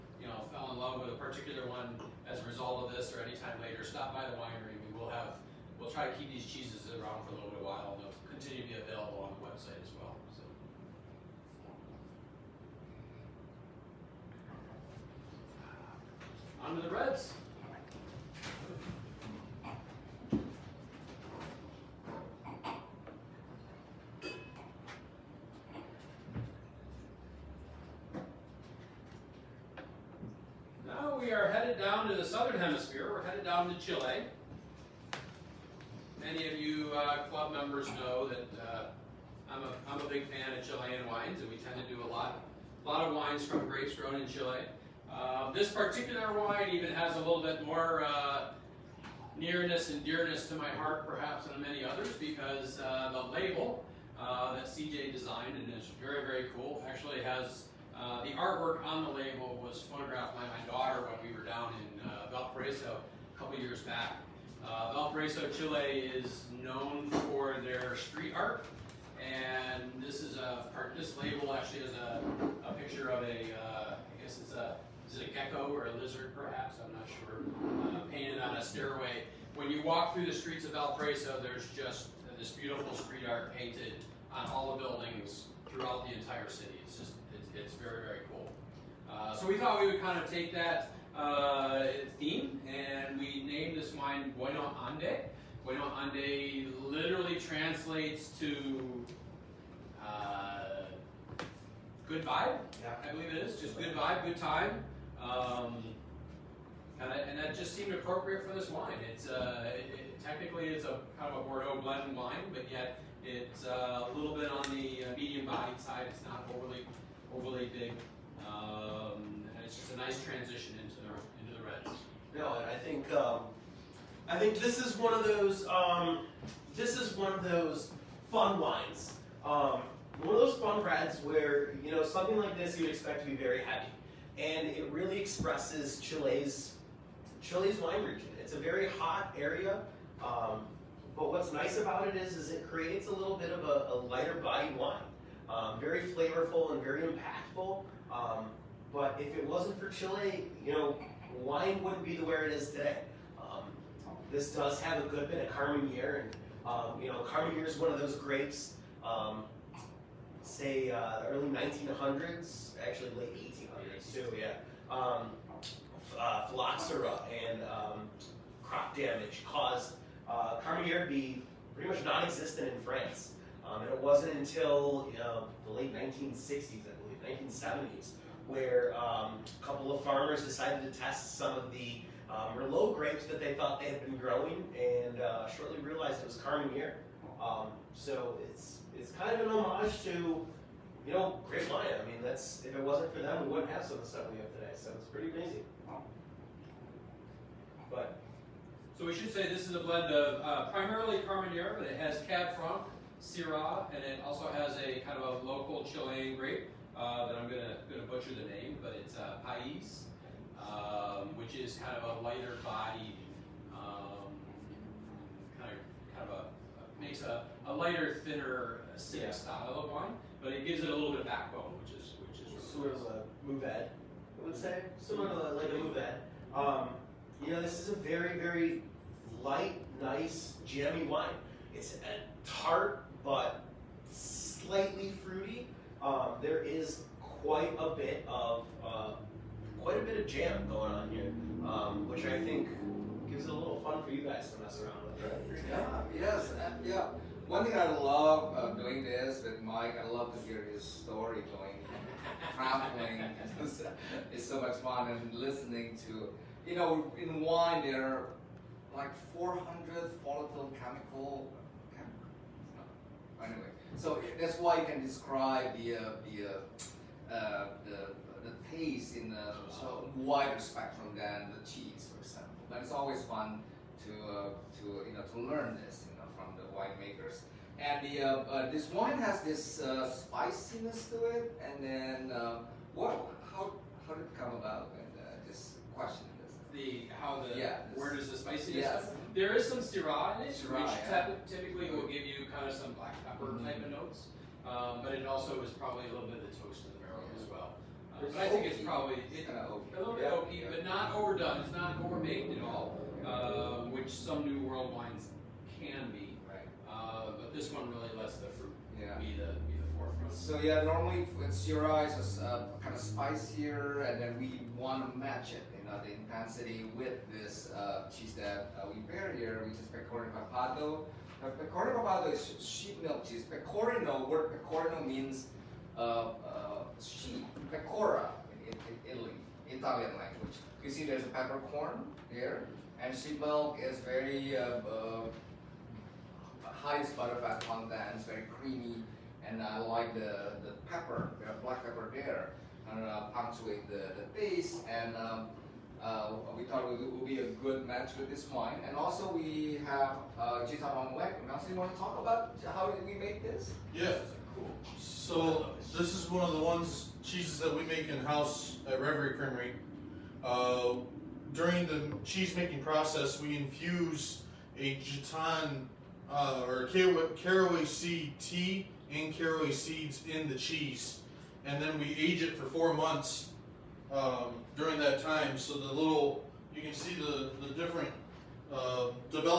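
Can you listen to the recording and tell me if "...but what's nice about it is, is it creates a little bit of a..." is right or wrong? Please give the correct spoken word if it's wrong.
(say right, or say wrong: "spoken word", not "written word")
right.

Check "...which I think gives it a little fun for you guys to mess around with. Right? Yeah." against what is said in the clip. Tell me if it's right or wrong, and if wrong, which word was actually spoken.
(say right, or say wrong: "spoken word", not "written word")
right.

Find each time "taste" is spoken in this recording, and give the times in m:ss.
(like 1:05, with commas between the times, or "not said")
4:28, 5:44.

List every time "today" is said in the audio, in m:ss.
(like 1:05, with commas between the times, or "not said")
2:32, 3:14.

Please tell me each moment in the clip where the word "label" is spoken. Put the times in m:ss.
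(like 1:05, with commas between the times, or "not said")
0:53, 0:59, 1:11.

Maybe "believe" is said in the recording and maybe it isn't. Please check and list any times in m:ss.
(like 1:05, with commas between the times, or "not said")
1:43, 2:56.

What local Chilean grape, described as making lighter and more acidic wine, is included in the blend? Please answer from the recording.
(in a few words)
Pais.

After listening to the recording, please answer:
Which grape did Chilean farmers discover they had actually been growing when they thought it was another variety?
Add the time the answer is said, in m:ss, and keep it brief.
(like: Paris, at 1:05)
Merlot, at 3:02.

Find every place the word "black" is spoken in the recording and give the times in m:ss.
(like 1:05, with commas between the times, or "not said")
4:52, 5:41.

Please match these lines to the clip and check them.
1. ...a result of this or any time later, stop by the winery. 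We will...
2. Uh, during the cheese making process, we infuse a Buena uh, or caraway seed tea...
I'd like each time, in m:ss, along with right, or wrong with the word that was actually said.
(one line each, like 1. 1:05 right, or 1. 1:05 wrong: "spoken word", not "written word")
1. 0:02 right
2. 6:00 wrong: "Gitan", not "Buena".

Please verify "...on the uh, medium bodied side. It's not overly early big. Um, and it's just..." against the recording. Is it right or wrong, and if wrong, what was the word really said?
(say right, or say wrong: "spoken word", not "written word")
wrong: "overly", not "early".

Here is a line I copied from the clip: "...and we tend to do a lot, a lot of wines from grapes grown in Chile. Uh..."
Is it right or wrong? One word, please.
right.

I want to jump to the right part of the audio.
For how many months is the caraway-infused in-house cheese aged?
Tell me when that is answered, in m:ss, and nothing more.
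6:12.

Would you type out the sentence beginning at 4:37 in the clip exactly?
And the, uh, uh, this wine has this uh, spiciness to it, and then what, how, how did it come about?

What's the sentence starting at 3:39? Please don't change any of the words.
style of wine, but it gives it a little bit of backbone, which is which is really sort nice.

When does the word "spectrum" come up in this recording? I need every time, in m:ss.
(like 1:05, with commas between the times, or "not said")
4:30.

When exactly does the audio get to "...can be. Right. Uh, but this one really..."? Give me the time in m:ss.
5:05.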